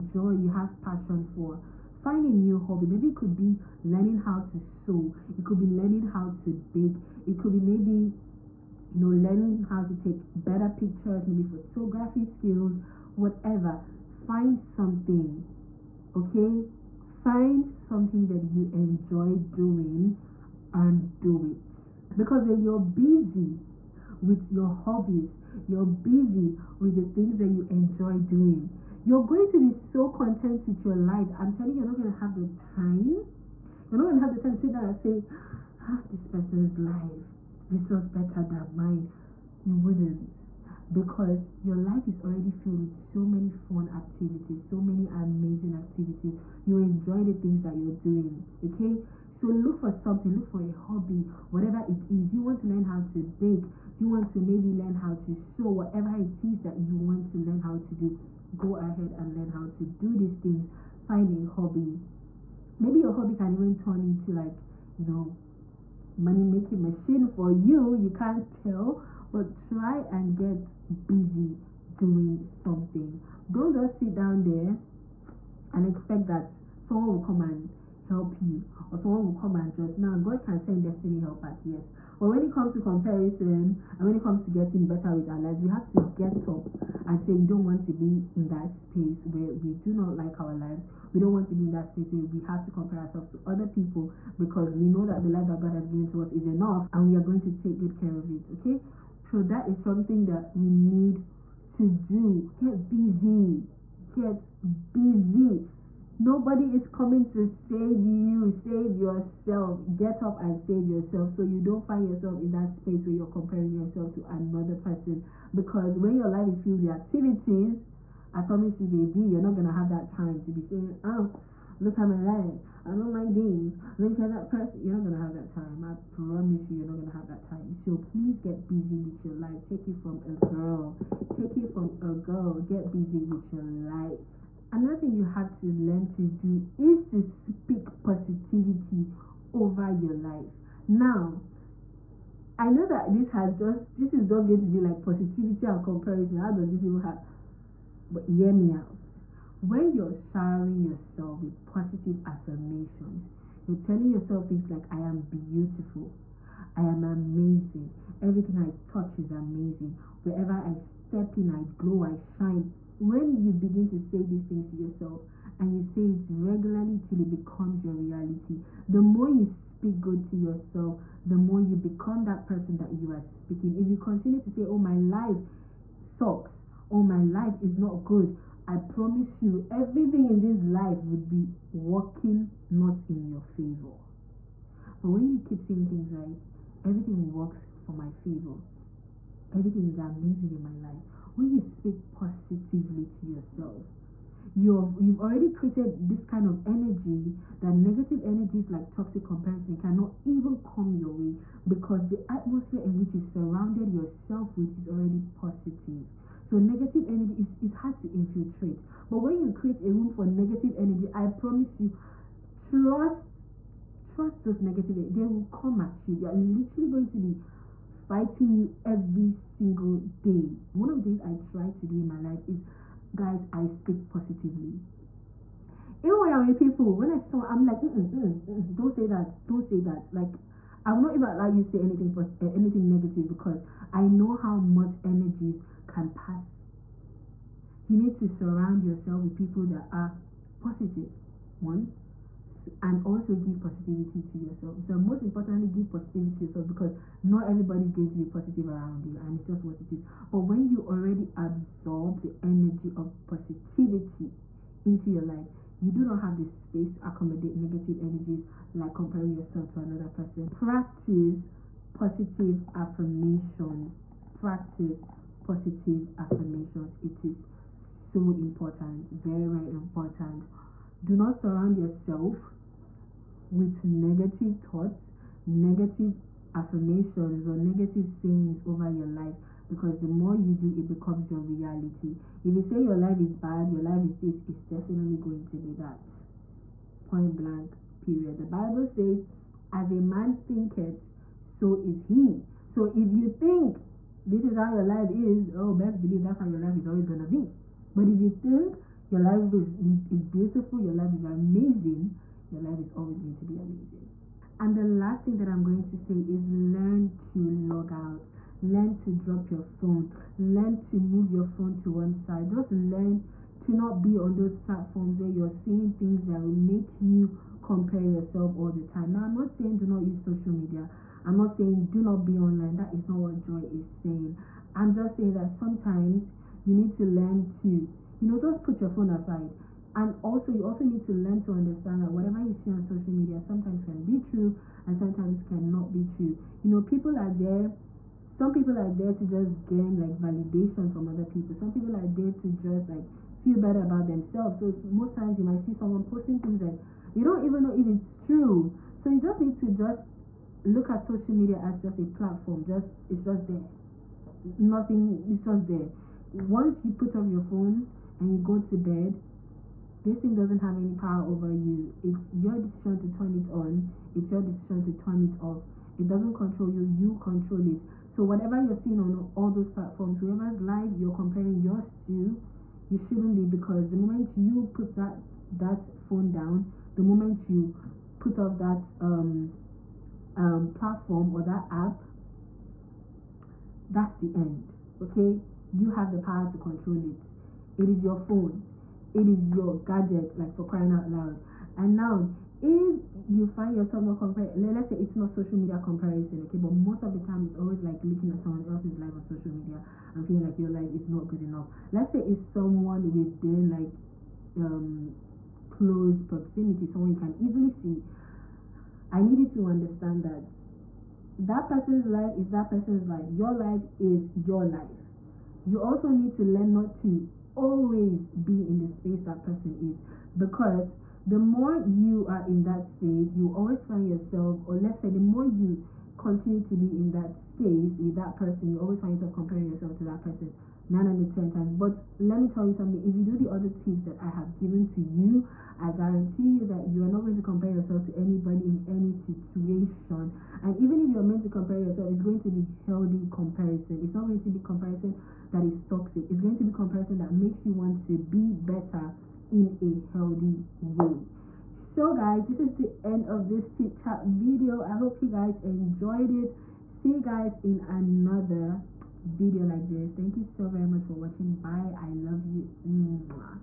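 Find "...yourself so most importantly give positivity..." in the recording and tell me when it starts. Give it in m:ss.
4:04.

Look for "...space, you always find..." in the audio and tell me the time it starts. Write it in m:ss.
7:02.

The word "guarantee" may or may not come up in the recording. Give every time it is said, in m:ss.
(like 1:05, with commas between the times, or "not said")
7:15.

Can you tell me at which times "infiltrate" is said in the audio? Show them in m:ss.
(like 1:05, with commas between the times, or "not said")
3:28.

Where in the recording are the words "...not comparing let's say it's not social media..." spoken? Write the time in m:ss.
6:34.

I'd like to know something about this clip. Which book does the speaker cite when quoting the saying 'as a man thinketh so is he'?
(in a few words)
the Bible.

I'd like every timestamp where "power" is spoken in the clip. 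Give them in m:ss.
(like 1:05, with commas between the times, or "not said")
6:00, 6:26.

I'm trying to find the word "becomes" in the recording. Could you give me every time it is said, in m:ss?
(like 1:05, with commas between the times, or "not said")
2:47, 2:51, 4:40.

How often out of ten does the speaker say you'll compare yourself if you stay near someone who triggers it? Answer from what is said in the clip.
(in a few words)
9 out of 10.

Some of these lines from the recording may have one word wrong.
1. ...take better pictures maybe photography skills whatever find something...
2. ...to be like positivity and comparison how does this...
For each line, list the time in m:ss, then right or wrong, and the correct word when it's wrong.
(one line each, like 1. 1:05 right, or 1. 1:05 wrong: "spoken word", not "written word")
1. 0:09 right
2. 2:24 right.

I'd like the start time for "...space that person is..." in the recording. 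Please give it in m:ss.
6:58.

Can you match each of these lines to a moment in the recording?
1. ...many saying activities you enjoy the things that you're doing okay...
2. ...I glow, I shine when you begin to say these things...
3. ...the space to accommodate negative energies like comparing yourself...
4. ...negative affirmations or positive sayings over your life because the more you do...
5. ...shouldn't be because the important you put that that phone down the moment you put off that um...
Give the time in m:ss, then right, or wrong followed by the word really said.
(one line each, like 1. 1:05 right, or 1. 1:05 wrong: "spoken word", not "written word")
1. 0:44 wrong: "amazing", not "saying"
2. 2:41 right
3. 4:16 right
4. 4:35 wrong: "negative", not "positive"
5. 6:12 wrong: "moment", not "important".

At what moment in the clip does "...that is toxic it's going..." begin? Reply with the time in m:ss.
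7:25.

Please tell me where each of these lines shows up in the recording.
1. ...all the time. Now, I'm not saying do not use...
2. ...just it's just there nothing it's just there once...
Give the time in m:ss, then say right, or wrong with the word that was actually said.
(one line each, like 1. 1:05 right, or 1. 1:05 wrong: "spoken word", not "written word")
1. 5:18 right
2. 5:52 right.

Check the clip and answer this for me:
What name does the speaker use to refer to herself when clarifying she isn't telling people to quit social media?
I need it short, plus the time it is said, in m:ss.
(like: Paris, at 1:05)
Joy, at 5:23.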